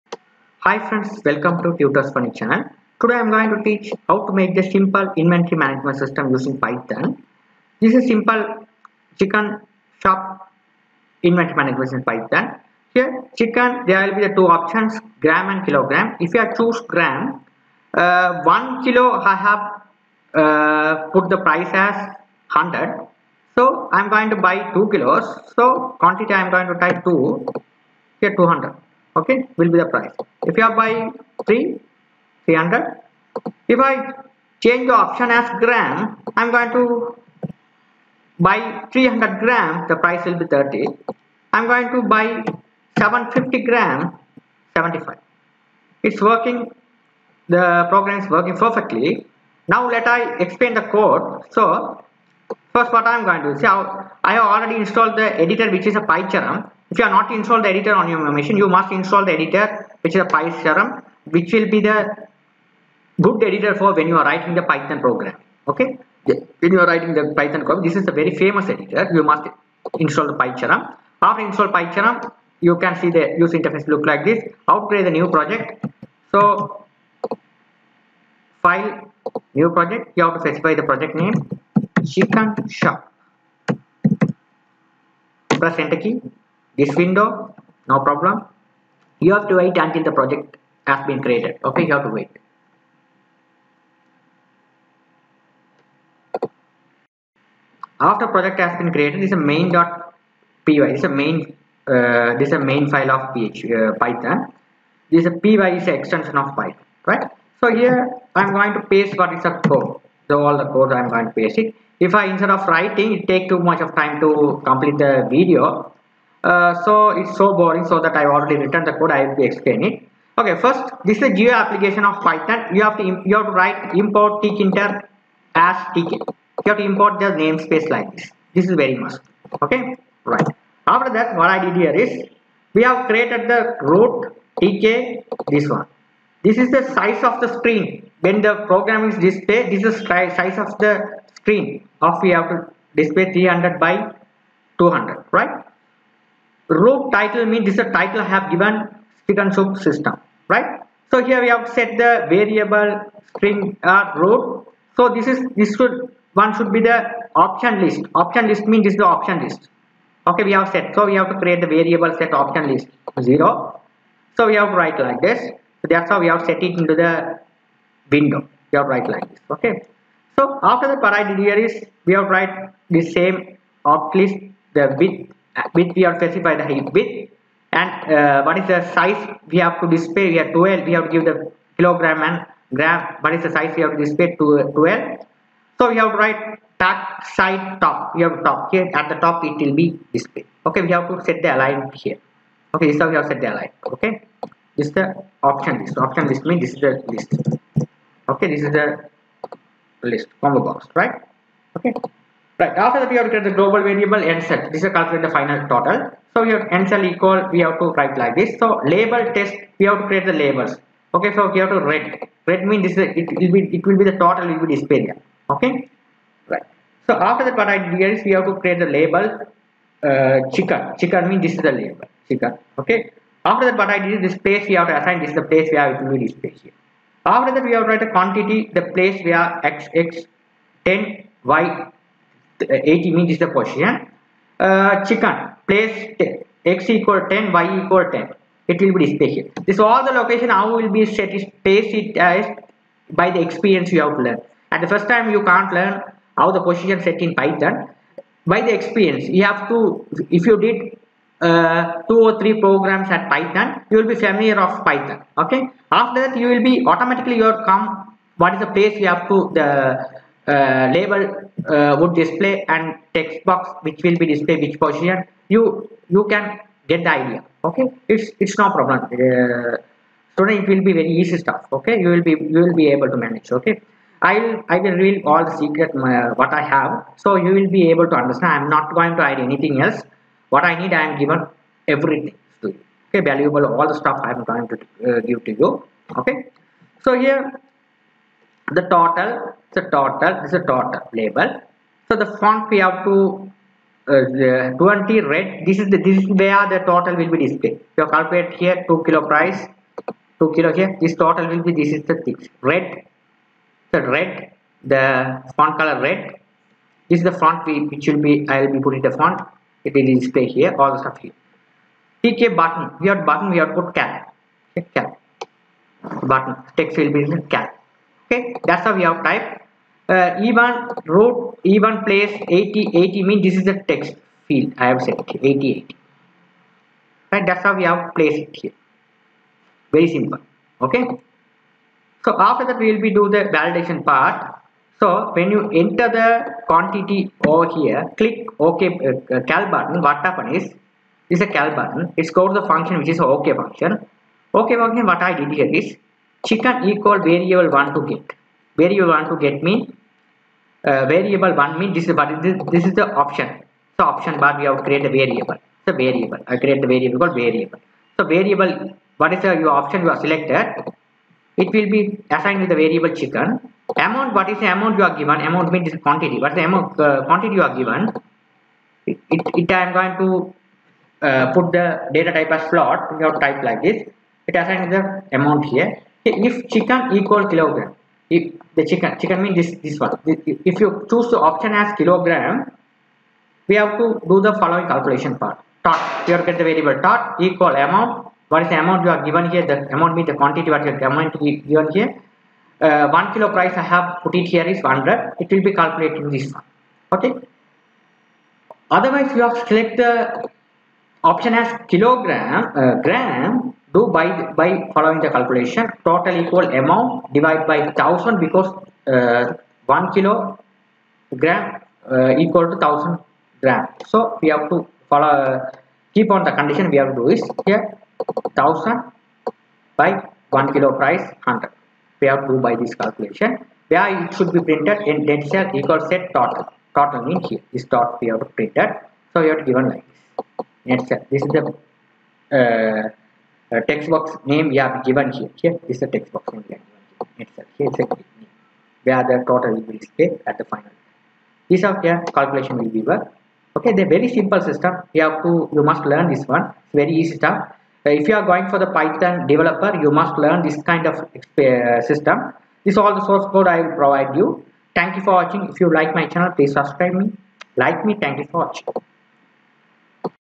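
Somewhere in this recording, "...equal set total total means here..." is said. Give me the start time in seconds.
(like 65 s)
425 s.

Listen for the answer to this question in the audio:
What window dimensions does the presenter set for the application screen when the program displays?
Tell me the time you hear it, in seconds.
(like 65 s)
143 s.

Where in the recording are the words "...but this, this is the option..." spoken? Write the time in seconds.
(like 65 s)
352 s.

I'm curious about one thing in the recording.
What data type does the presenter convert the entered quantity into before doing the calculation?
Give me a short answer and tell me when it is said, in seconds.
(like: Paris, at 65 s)
float, at 372 s.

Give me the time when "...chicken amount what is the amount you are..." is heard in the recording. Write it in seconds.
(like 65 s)
363 s.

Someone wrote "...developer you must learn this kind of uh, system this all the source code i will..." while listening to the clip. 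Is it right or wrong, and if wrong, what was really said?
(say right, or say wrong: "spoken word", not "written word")
right.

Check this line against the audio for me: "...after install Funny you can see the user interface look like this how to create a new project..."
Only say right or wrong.
wrong.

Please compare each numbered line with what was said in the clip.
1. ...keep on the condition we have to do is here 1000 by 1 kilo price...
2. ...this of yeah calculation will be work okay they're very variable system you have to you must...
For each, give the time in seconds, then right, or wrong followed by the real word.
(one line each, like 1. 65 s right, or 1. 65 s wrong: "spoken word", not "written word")
1. 416 s right
2. 441 s wrong: "simple", not "variable".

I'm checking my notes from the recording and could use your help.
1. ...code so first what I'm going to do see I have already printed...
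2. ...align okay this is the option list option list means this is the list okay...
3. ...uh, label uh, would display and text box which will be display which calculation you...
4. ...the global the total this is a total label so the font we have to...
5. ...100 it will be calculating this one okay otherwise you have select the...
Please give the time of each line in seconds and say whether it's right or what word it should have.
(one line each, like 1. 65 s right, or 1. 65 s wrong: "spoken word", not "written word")
1. 50 s wrong: "installed", not "printed"
2. 193 s right
3. 260 s wrong: "position", not "calculation"
4. 288 s wrong: "total", not "global"
5. 394 s right.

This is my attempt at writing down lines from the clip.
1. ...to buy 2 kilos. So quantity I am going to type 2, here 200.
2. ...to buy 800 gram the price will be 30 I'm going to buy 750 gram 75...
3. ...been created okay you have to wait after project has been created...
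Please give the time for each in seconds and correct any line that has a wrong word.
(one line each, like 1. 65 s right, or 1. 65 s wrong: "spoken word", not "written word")
1. 24 s right
2. 36 s wrong: "300", not "800"
3. 91 s right.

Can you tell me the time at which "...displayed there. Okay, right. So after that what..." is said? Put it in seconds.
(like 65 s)
214 s.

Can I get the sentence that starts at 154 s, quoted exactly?
So this is this should one should be the option list.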